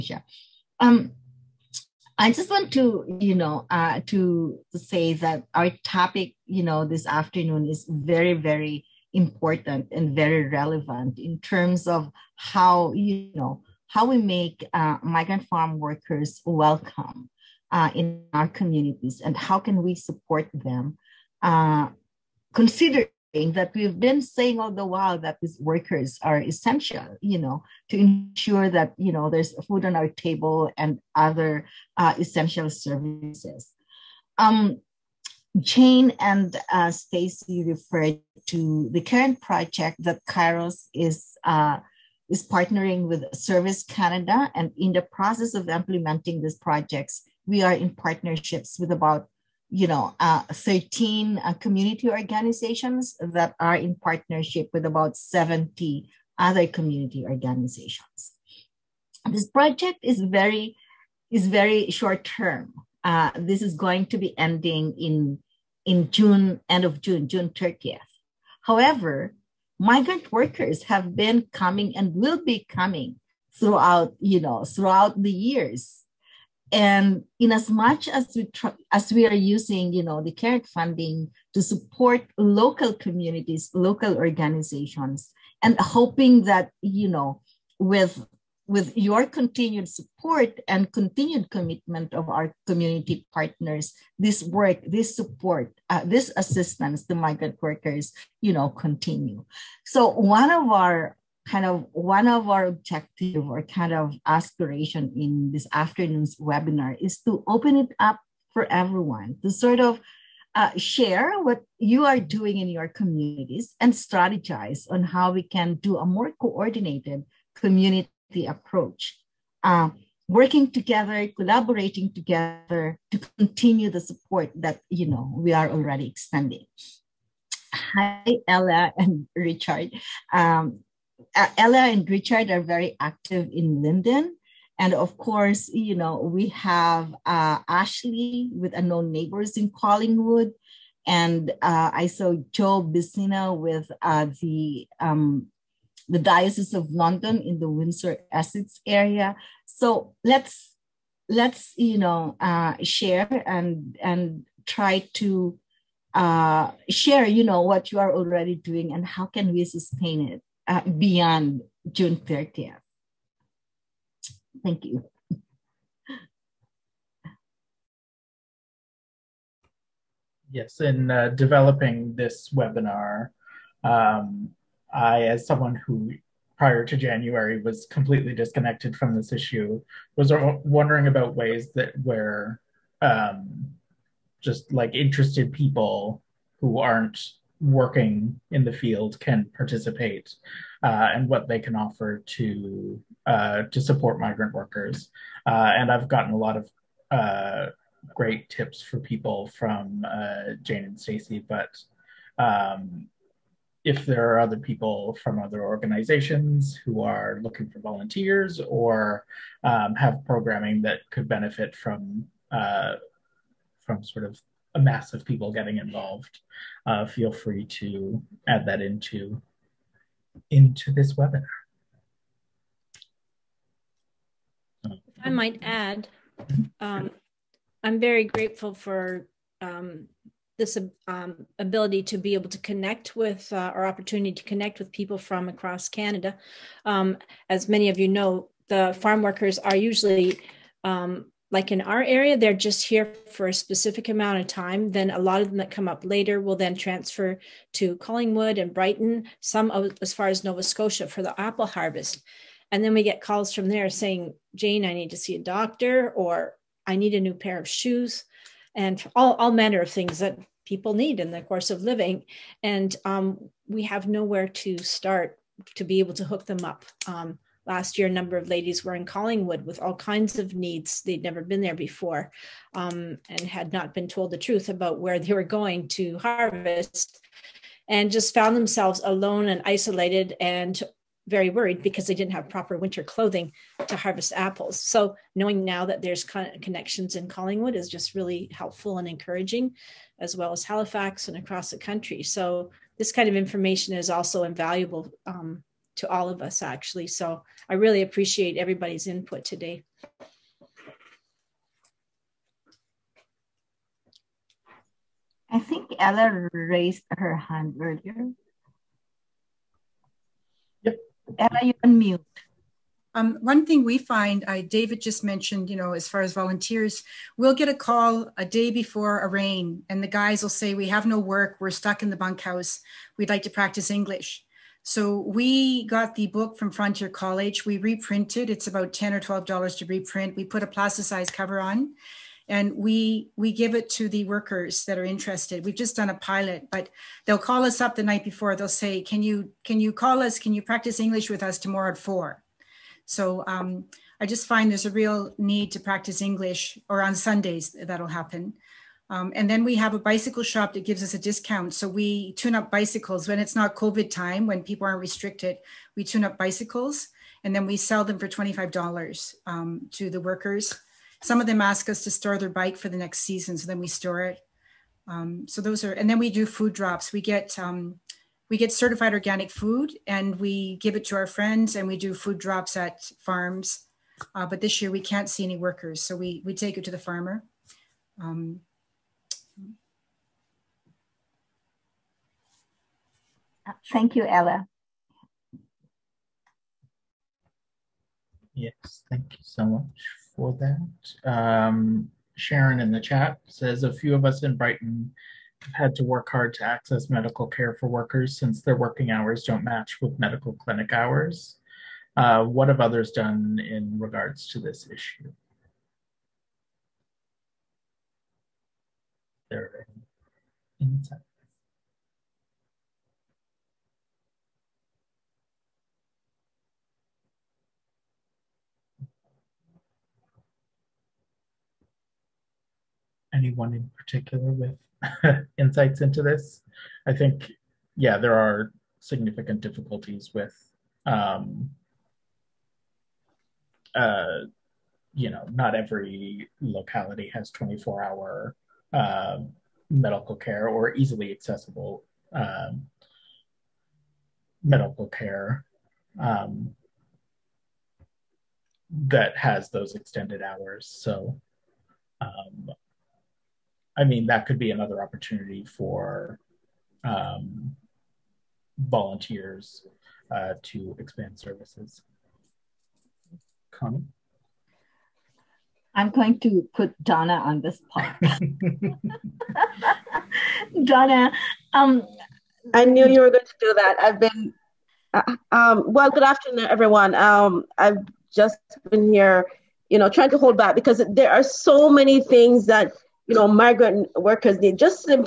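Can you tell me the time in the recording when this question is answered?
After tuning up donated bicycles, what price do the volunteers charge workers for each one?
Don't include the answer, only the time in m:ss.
5:58.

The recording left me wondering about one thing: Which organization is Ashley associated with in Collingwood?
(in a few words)
Unknown Neighbors.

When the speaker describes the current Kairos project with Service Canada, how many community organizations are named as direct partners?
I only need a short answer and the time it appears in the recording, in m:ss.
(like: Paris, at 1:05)
13, at 0:50.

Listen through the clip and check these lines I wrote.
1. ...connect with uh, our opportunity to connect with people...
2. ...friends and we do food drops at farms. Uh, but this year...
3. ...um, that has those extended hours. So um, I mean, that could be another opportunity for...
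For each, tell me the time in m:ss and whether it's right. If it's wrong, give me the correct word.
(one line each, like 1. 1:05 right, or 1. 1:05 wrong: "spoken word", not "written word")
1. 3:52 right
2. 6:11 right
3. 7:26 right.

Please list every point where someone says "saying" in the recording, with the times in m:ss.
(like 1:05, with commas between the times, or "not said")
0:24, 4:13.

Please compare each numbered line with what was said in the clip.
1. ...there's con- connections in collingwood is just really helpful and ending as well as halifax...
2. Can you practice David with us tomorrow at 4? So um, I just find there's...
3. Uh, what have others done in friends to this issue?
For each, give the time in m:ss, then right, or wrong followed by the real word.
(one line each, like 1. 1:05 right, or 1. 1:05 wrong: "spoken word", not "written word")
1. 4:46 wrong: "encouraging", not "ending"
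2. 5:40 wrong: "English", not "David"
3. 6:42 wrong: "regards", not "friends".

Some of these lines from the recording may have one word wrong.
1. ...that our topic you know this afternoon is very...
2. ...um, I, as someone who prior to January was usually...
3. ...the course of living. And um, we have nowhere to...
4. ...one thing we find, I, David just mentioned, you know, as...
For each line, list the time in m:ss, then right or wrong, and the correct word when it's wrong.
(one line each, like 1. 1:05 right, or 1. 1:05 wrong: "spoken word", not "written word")
1. 0:05 right
2. 2:53 wrong: "completely", not "usually"
3. 4:21 right
4. 5:13 right.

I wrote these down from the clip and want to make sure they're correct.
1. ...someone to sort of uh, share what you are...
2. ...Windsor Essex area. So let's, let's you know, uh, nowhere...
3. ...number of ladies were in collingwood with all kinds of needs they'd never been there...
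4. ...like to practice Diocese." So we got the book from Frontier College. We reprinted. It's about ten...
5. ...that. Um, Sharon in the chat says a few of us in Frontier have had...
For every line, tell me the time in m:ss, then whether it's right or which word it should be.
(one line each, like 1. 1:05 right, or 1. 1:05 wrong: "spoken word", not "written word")
1. 1:48 wrong: "everyone", not "someone"
2. 2:27 wrong: "share", not "nowhere"
3. 4:28 right
4. 5:23 wrong: "English", not "Diocese"
5. 6:30 wrong: "Brighton", not "Frontier".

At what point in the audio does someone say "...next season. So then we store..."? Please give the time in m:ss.
6:02.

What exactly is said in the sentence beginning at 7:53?
I've been, uh, um, well, good afternoon, everyone.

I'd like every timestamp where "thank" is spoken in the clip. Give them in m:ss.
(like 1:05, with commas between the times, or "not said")
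2:44, 6:23, 6:29.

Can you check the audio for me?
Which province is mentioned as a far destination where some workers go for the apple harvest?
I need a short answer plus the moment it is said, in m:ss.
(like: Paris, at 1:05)
Nova Scotia, at 4:10.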